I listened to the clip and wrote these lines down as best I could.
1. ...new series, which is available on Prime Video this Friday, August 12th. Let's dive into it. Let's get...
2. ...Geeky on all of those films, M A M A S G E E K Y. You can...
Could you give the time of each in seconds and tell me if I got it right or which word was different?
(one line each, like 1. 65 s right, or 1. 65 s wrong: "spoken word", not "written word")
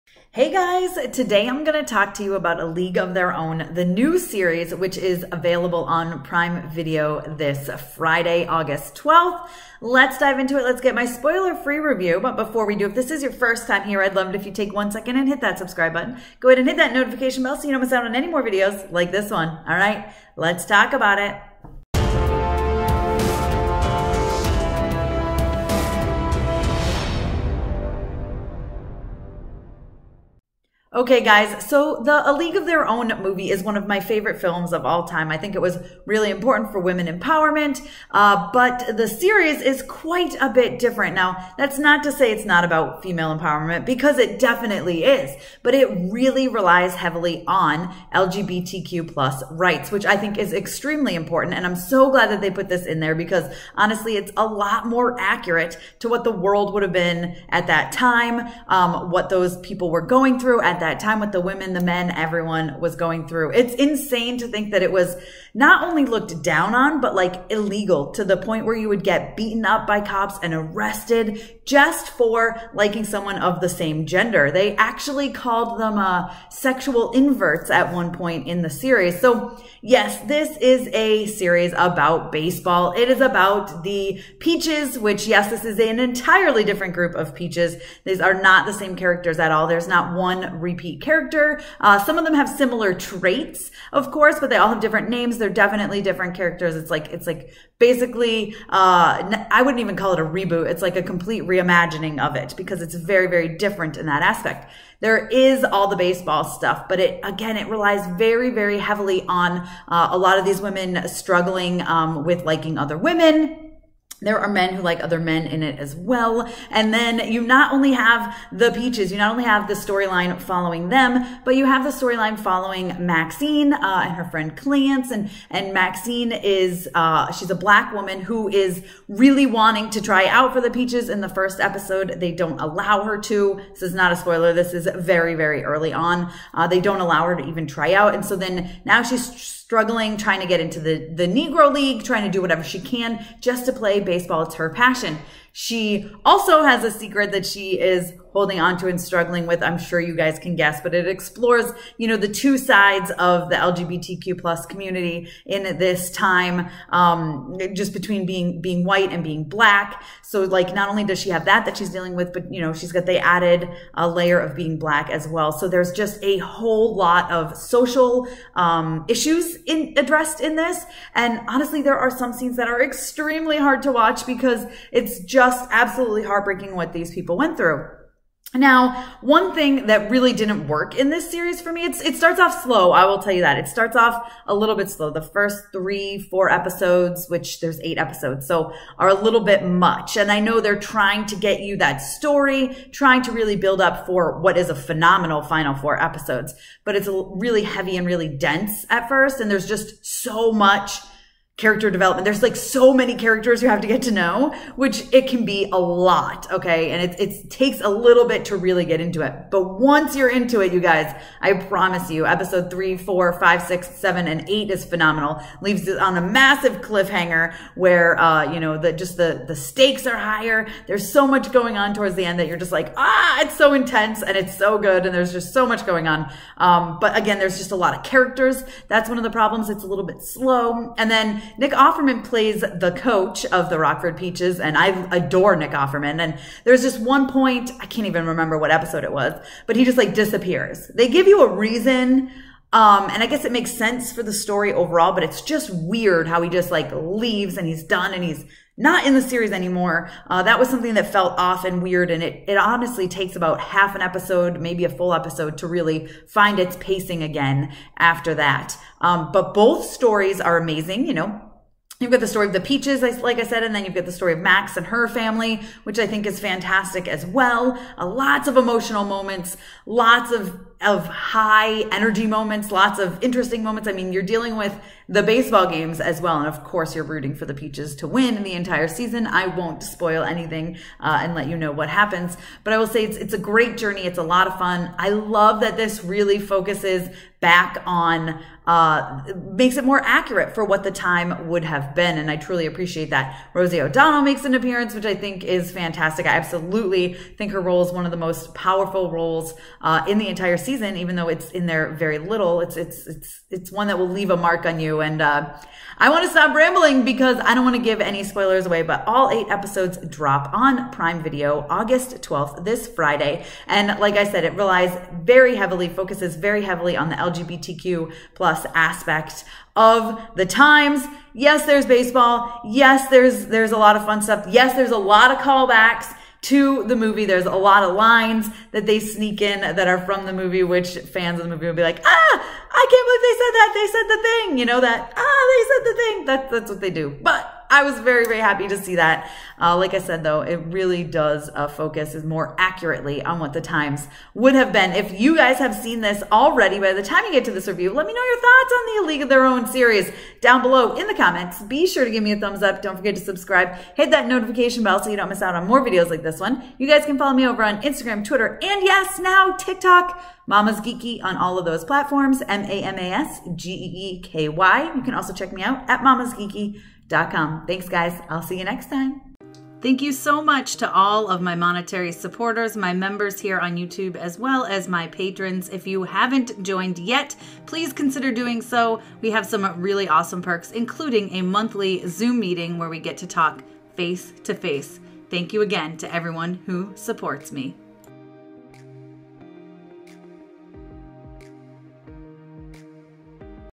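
1. 3 s right
2. 360 s wrong: "platforms", not "films".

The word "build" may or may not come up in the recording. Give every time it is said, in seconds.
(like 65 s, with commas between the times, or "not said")
193 s.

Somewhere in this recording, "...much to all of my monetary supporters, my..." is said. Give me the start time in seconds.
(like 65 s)
370 s.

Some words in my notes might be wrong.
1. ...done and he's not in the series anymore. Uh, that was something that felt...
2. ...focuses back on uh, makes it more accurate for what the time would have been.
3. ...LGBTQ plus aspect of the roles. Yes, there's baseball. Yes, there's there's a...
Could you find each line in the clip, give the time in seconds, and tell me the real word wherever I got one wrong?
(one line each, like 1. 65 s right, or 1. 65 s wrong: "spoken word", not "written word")
1. 247 s right
2. 286 s right
3. 317 s wrong: "times", not "roles".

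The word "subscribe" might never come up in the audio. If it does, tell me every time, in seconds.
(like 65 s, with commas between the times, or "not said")
15 s, 353 s.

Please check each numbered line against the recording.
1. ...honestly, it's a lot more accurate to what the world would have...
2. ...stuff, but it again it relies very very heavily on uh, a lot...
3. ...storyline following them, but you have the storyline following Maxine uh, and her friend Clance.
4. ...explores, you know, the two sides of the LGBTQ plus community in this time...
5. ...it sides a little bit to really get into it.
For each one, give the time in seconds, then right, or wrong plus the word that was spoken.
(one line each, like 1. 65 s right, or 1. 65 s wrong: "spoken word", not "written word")
1. 53 s right
2. 106 s right
3. 119 s right
4. 151 s right
5. 207 s wrong: "takes", not "sides".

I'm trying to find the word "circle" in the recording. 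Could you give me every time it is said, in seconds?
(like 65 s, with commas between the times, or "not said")
not said.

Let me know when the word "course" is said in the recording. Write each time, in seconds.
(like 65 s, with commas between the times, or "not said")
94 s, 276 s.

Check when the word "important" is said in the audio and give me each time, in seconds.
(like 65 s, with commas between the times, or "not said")
36 s, 51 s.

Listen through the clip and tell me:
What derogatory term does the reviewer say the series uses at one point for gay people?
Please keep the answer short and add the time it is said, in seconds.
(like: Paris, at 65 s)
sexual inverts, at 76 s.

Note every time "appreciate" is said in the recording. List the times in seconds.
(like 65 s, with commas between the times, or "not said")
292 s.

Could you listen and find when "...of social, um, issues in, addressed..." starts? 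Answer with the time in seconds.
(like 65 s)
167 s.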